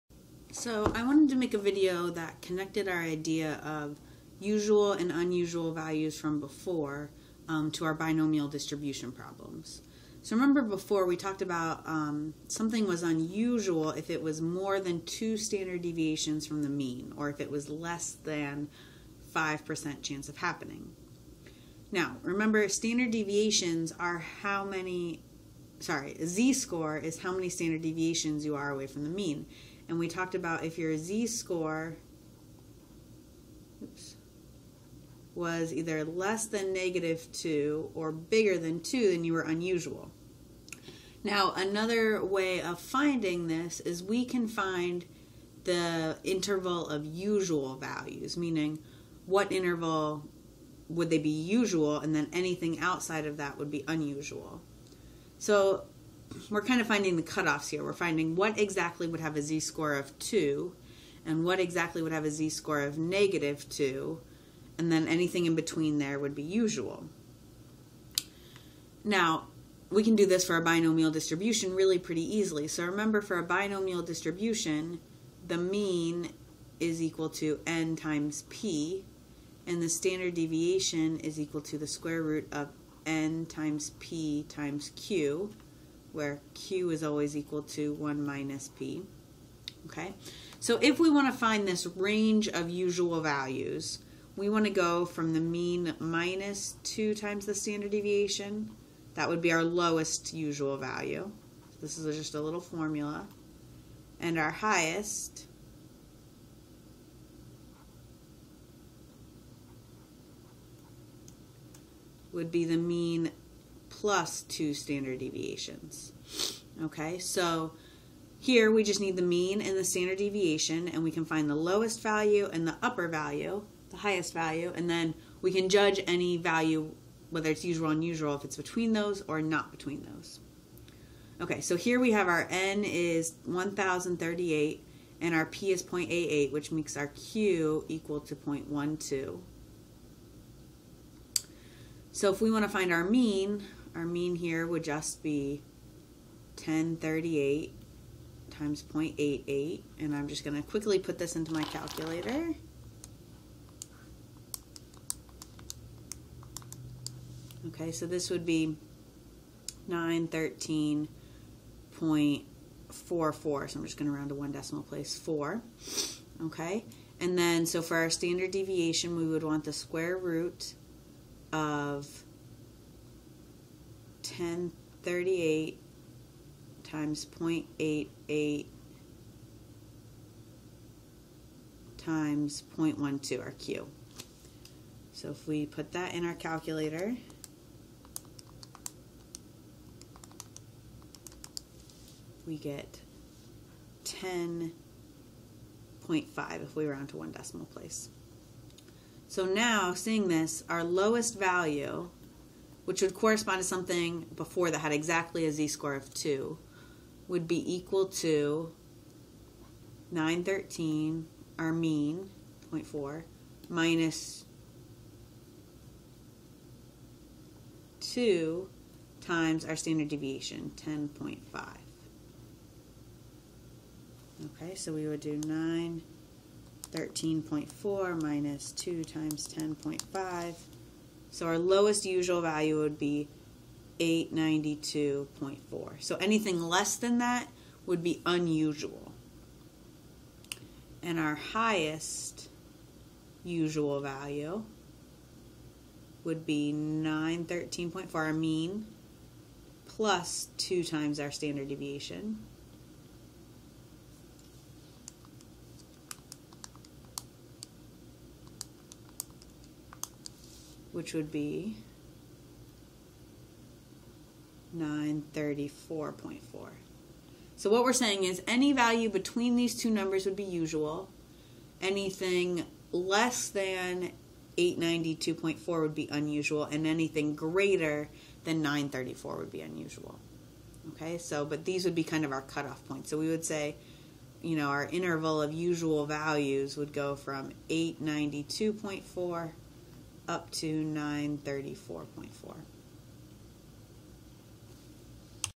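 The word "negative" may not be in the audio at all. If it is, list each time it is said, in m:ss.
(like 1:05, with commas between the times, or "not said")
0:36, 1:02.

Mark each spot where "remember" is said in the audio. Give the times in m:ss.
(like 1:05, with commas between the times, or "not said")
0:10, 0:22, 1:12.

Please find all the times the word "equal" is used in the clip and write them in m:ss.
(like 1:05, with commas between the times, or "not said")
1:17, 1:21, 1:27, 2:17, 3:27.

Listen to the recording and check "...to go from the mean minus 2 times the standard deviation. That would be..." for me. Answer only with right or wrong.
right.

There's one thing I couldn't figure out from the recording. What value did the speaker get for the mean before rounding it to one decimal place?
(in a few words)
913.44.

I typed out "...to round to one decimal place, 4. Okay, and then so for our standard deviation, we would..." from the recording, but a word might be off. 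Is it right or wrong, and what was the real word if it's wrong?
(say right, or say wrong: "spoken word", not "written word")
right.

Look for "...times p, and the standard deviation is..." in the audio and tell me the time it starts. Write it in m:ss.
1:17.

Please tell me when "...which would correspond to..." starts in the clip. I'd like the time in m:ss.
3:22.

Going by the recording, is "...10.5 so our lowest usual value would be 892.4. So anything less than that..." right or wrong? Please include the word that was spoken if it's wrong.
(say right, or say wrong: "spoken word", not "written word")
right.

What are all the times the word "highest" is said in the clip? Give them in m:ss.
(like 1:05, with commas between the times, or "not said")
1:44, 2:03, 4:01.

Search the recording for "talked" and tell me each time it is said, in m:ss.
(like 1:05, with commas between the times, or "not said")
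0:11, 0:30.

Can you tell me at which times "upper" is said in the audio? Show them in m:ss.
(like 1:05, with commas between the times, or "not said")
2:02.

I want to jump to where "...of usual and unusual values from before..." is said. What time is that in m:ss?
0:03.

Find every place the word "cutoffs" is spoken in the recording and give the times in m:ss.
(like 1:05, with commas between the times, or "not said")
0:57, 4:42.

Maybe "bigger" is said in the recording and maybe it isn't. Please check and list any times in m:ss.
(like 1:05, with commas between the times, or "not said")
0:38.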